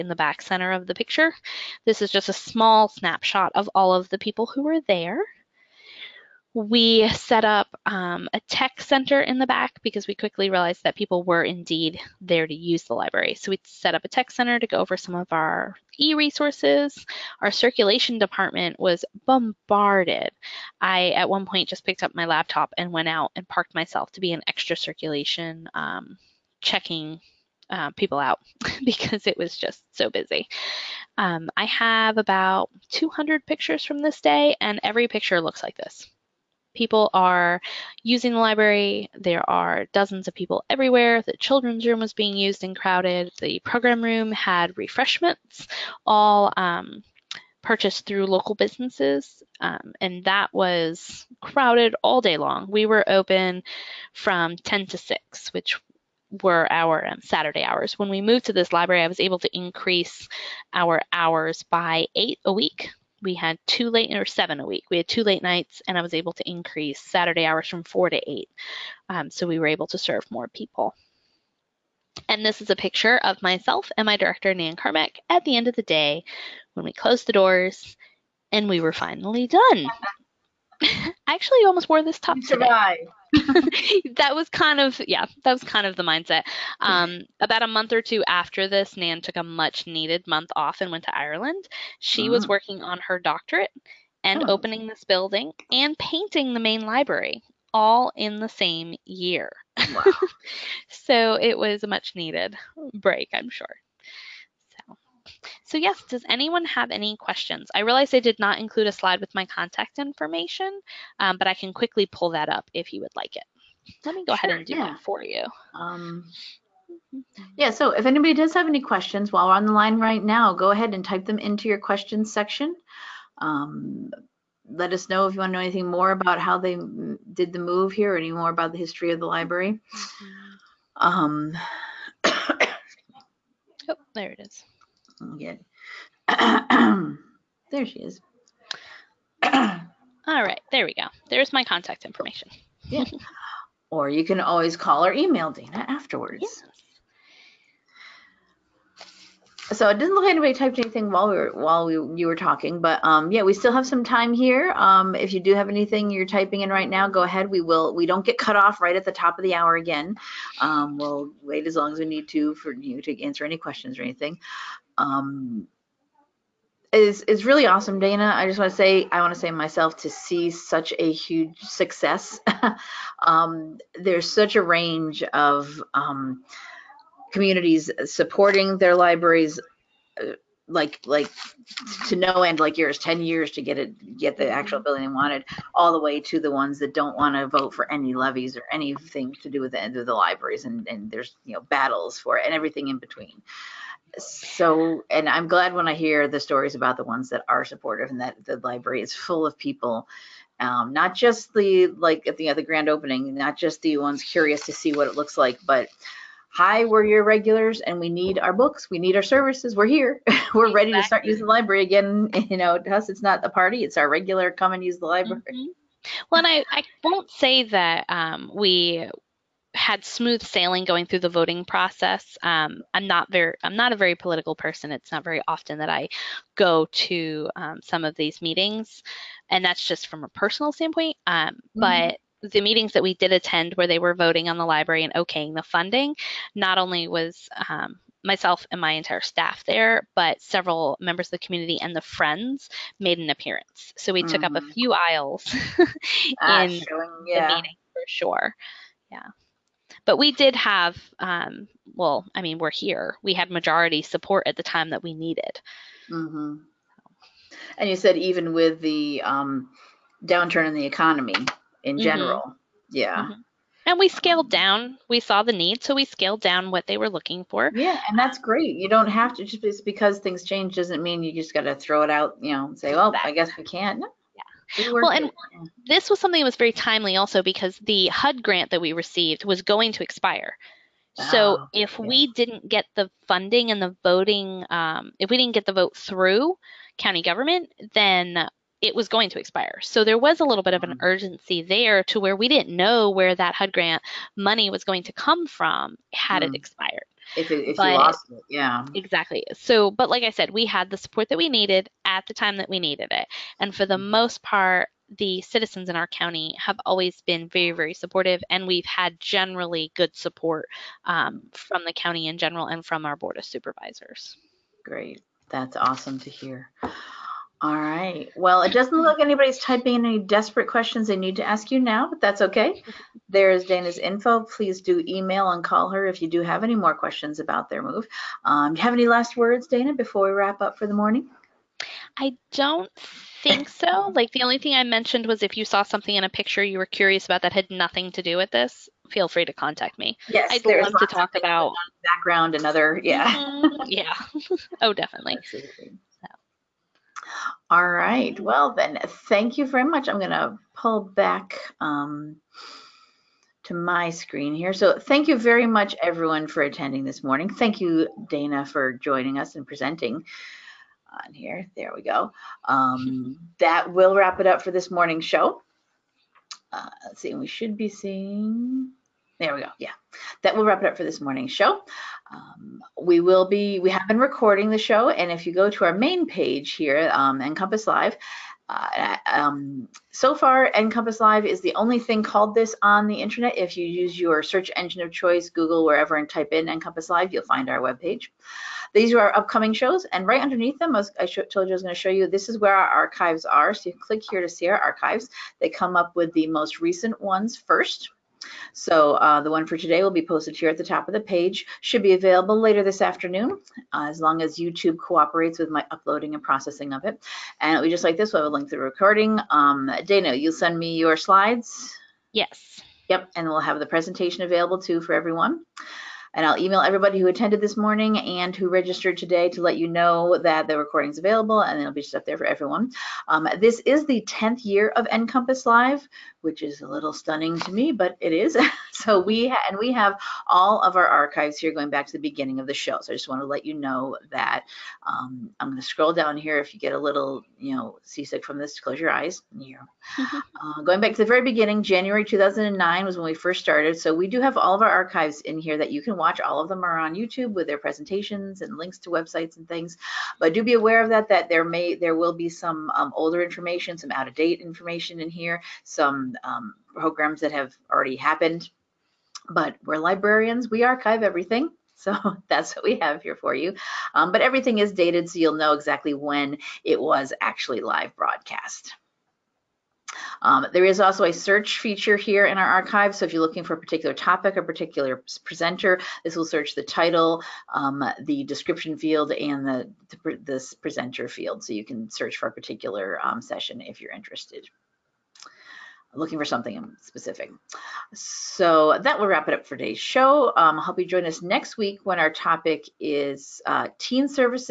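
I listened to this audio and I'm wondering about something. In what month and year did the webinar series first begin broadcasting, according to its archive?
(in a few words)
January 2009.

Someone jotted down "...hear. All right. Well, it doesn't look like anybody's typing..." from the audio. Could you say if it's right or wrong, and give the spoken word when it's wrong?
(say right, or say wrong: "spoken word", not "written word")
right.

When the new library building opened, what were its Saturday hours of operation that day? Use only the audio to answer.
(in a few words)
10 to 6.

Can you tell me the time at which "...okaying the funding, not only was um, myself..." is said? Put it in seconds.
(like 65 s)
235 s.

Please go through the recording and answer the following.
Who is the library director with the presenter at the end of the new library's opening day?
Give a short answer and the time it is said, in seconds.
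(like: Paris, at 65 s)
Nan Carmack, at 74 s.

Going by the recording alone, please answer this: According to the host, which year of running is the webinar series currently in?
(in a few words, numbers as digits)
10th.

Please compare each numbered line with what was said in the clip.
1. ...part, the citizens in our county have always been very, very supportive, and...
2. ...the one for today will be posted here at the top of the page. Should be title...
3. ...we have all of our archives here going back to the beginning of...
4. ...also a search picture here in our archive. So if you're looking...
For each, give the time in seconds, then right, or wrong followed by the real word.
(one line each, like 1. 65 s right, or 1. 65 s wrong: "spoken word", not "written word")
1. 304 s right
2. 399 s wrong: "available", not "title"
3. 429 s right
4. 470 s wrong: "feature", not "picture".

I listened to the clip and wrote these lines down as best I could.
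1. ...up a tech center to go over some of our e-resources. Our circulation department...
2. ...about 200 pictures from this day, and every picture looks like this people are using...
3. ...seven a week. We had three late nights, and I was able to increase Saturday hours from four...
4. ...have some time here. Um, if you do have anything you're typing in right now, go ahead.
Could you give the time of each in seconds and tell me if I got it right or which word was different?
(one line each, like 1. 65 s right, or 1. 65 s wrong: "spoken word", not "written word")
1. 13 s right
2. 32 s right
3. 64 s wrong: "two", not "three"
4. 153 s right.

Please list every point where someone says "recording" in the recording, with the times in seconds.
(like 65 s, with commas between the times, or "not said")
374 s, 408 s, 420 s.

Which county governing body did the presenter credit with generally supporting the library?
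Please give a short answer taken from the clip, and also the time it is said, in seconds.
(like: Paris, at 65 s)
Board of Supervisors, at 313 s.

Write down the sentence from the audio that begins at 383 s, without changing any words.
If you use your search engine of choice, Google, wherever, and type in NCompass Live, you'll find our webpage.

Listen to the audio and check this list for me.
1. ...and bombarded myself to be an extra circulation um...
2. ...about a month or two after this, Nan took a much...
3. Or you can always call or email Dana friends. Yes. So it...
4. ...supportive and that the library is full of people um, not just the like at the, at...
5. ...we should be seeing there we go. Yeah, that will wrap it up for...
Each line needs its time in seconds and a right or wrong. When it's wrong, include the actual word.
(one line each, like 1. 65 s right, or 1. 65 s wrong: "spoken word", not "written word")
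1. 23 s wrong: "parked", not "bombarded"
2. 87 s right
3. 143 s wrong: "afterwards", not "friends"
4. 197 s right
5. 367 s right.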